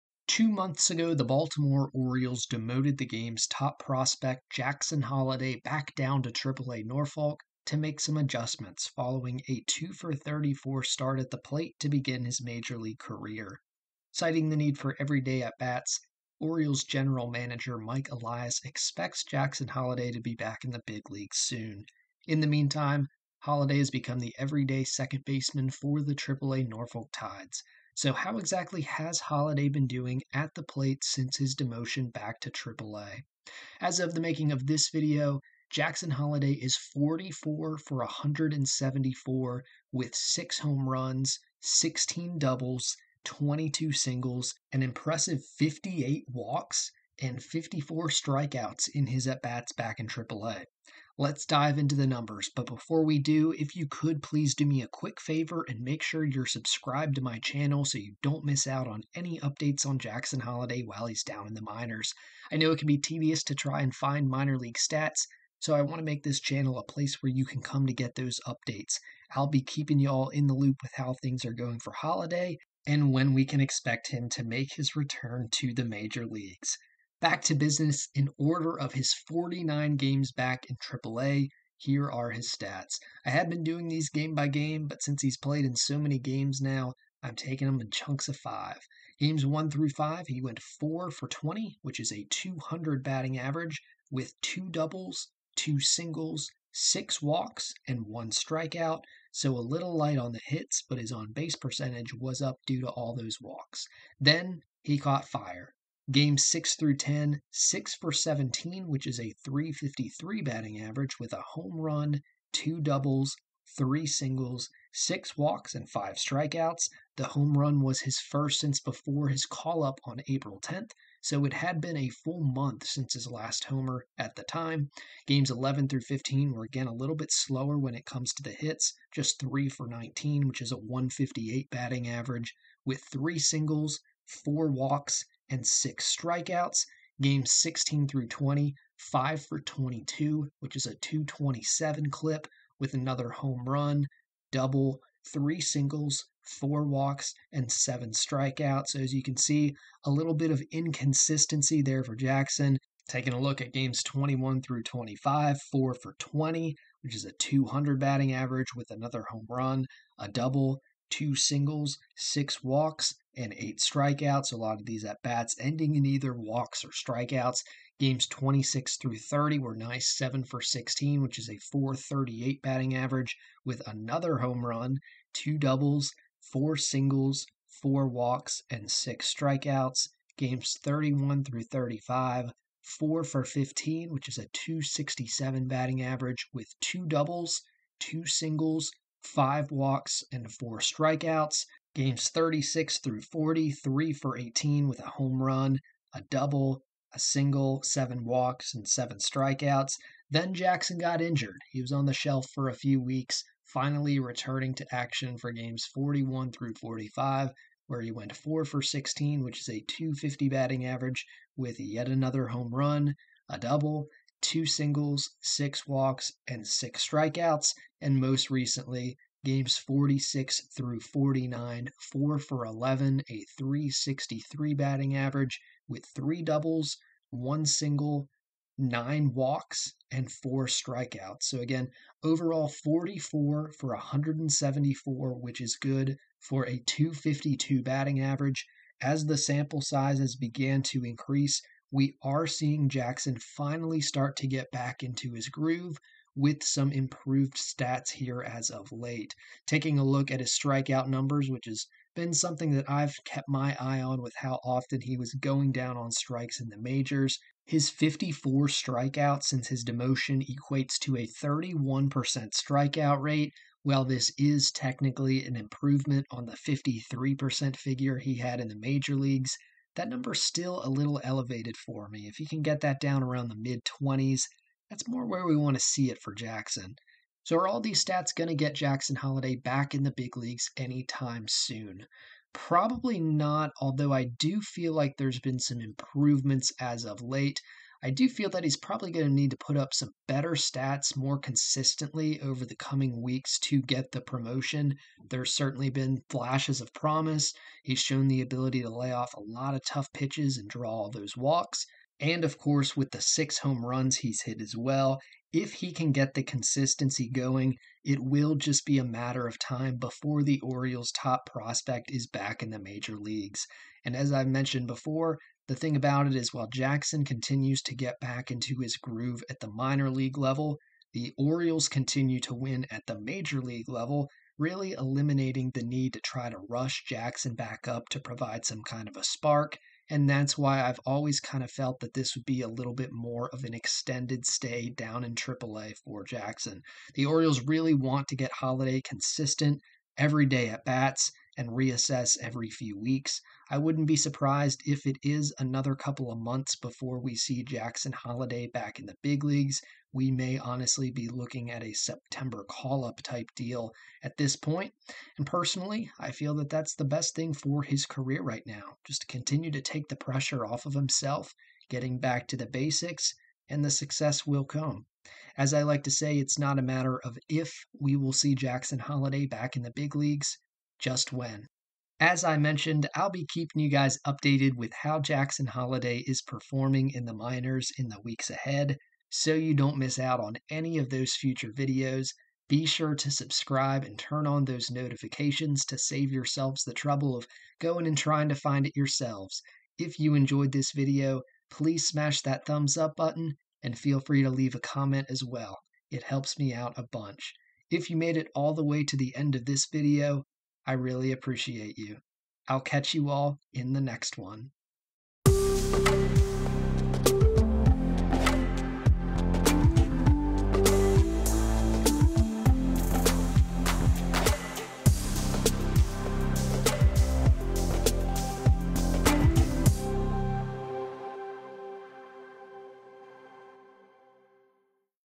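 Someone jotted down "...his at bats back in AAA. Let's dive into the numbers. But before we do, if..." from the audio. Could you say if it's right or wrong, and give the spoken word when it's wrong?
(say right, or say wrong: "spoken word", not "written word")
right.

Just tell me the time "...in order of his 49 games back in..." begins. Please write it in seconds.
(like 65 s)
78 s.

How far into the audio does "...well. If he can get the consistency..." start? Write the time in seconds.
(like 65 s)
304 s.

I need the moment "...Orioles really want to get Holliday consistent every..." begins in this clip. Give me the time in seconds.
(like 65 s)
337 s.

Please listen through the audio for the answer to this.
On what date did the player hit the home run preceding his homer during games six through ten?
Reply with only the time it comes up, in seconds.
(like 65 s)
120 s.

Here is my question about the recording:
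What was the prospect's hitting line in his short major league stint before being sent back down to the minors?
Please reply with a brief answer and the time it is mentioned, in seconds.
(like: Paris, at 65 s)
2 for 34, at 9 s.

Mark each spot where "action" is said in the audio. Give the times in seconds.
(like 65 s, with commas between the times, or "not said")
204 s.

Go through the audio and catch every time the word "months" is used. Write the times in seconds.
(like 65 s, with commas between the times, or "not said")
0 s, 122 s, 346 s.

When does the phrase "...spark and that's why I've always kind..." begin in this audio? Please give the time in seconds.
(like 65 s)
329 s.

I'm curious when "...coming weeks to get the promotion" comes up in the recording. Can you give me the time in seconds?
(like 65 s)
292 s.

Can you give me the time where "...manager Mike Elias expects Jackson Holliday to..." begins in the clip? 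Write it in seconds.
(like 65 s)
17 s.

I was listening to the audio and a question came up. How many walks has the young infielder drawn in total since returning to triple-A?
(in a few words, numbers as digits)
58.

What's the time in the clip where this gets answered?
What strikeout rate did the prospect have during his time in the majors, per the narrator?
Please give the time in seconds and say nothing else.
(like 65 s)
266 s.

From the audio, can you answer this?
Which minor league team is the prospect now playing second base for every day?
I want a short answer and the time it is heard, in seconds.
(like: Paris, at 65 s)
Norfolk Tides, at 26 s.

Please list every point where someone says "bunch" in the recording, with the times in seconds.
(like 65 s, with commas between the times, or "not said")
397 s.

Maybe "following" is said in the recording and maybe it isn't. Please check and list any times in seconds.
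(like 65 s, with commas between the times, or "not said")
8 s.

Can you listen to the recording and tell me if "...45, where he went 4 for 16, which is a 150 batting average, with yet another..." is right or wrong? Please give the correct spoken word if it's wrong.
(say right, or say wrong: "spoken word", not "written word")
wrong: "250", not "150".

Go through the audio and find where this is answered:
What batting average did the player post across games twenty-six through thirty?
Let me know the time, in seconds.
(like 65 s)
171 s.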